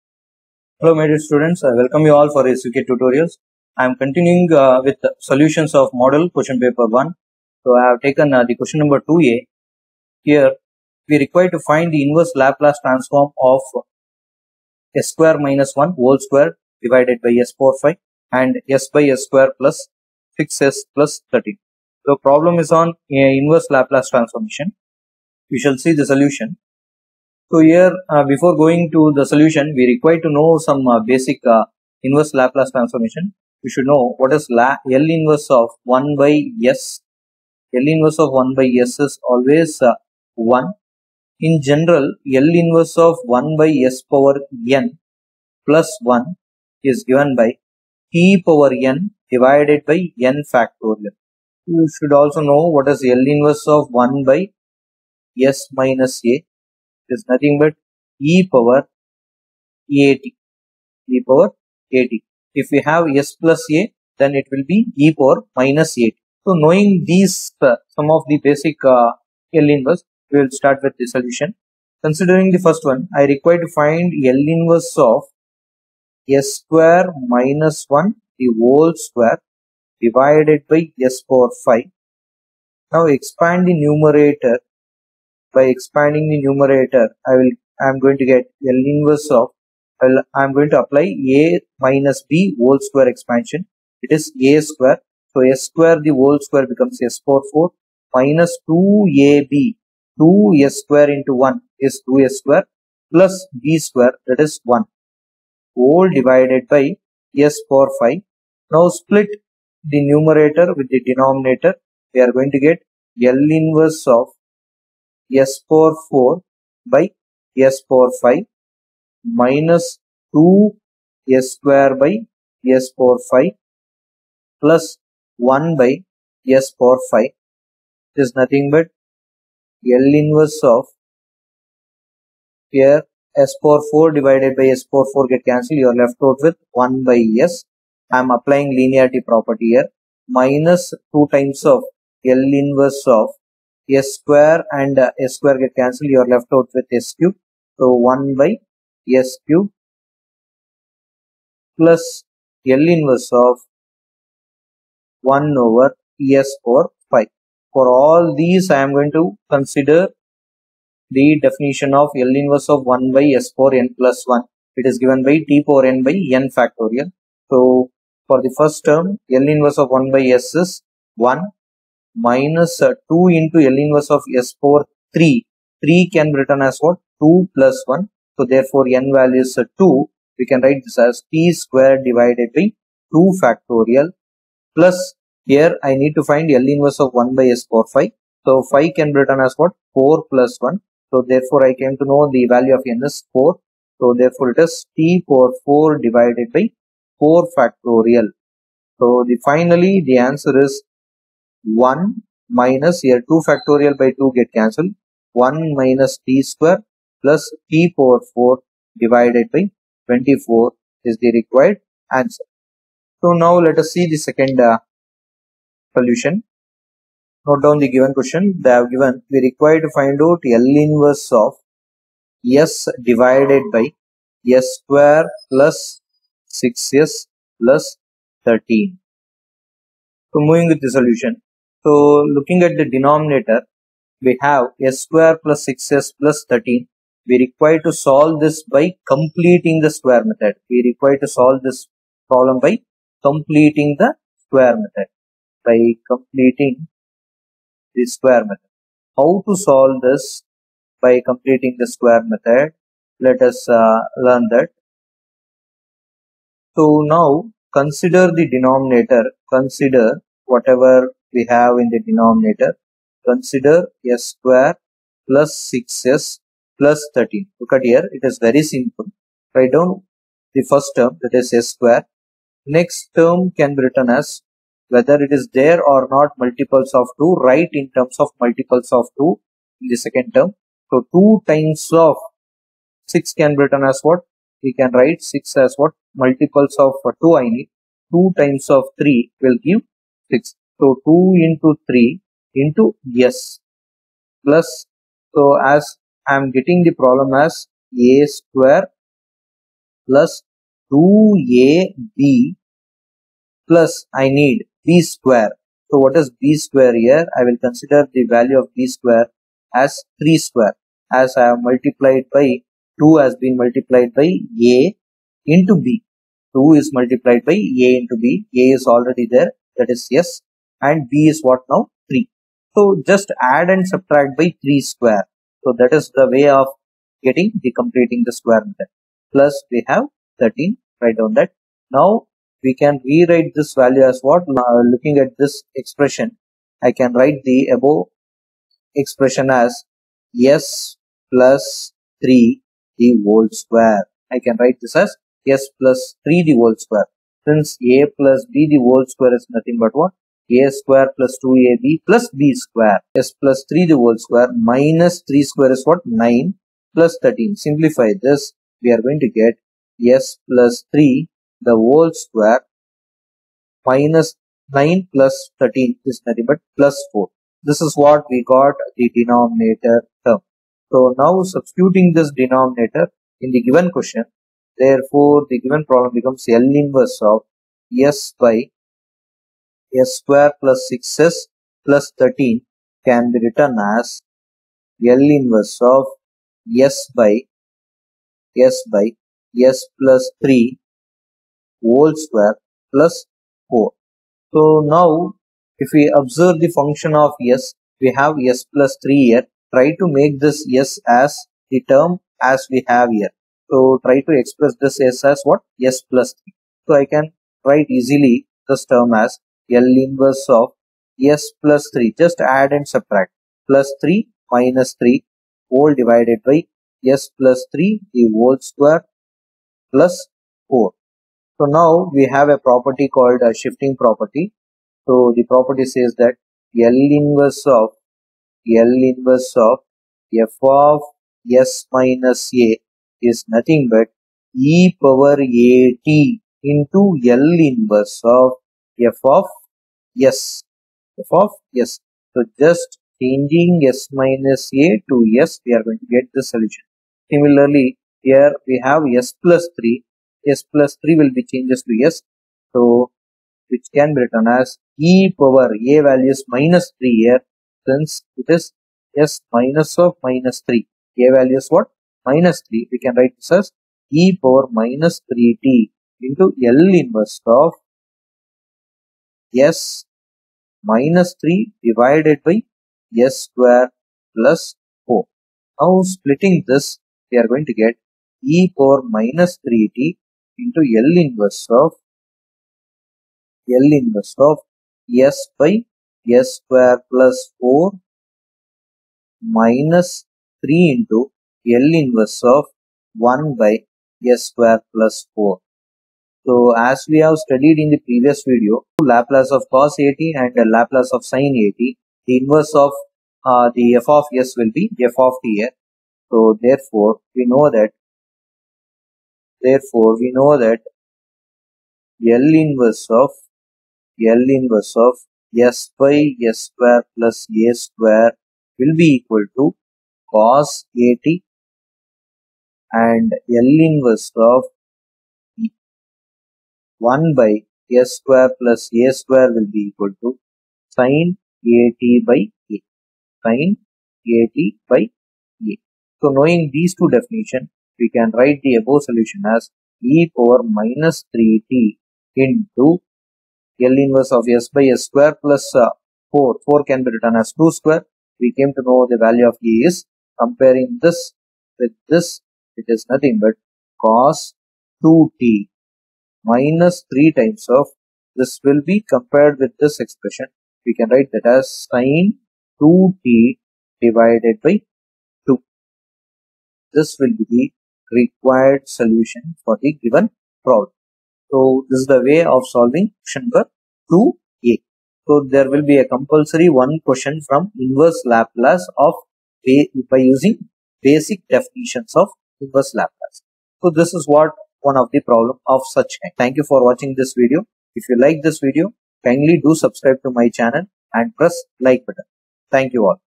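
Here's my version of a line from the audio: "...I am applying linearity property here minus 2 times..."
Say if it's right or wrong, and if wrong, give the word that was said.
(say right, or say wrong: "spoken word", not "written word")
right.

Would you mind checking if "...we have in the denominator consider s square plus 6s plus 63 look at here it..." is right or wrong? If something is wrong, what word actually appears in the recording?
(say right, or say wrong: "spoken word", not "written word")
wrong: "13", not "63".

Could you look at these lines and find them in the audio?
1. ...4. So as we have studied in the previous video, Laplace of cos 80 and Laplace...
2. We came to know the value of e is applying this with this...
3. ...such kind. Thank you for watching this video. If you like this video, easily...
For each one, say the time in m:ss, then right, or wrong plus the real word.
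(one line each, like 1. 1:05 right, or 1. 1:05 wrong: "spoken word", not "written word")
1. 8:15 right
2. 9:08 wrong: "comparing", not "applying"
3. 9:45 wrong: "kindly", not "easily".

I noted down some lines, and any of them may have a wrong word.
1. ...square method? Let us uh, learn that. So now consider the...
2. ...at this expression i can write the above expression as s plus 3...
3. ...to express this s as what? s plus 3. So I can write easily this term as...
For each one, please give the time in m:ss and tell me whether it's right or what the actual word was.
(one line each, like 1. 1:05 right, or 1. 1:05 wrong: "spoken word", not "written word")
1. 4:11 right
2. 5:35 right
3. 6:44 right.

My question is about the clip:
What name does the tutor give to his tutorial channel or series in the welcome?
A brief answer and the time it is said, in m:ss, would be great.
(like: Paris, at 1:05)
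SVK tutorials, at 0:02.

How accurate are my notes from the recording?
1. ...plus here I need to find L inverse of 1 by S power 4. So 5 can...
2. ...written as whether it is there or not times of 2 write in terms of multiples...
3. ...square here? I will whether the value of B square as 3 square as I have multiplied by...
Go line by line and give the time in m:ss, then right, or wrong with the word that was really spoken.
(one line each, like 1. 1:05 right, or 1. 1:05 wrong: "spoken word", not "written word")
1. 3:04 wrong: "5", not "4"
2. 4:33 wrong: "multiples", not "times"
3. 5:06 wrong: "consider", not "whether".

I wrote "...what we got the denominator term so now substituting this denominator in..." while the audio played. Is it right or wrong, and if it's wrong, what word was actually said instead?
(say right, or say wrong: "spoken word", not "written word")
right.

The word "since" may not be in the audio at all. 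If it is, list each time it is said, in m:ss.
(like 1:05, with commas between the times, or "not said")
5:47, 7:37.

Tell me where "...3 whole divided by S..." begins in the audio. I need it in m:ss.
6:55.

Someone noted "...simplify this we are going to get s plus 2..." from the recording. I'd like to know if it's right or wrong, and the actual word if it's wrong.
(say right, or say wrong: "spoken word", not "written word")
wrong: "3", not "2".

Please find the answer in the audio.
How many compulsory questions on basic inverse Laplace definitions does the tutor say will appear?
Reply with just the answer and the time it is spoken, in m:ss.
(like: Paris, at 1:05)
1, at 9:36.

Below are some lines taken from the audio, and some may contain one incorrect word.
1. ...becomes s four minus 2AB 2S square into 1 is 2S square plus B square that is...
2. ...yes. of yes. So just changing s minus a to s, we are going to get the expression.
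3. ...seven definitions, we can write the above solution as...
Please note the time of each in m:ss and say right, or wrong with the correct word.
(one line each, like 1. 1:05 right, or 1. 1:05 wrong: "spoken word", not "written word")
1. 1:36 right
2. 7:20 wrong: "solution", not "expression"
3. 8:56 wrong: "two", not "seven".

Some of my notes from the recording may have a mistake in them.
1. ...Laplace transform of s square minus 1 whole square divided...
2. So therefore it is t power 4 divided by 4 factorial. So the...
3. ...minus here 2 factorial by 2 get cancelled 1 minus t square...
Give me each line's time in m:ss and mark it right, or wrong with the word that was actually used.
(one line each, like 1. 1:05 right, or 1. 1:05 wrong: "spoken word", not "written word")
1. 0:12 right
2. 3:13 right
3. 3:22 right.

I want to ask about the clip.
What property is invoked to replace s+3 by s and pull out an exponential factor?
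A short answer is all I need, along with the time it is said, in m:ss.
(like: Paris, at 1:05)
Shifting property, at 7:03.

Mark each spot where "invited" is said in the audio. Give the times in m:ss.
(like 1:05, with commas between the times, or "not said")
not said.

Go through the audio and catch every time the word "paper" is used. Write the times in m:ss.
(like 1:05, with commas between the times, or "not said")
0:06.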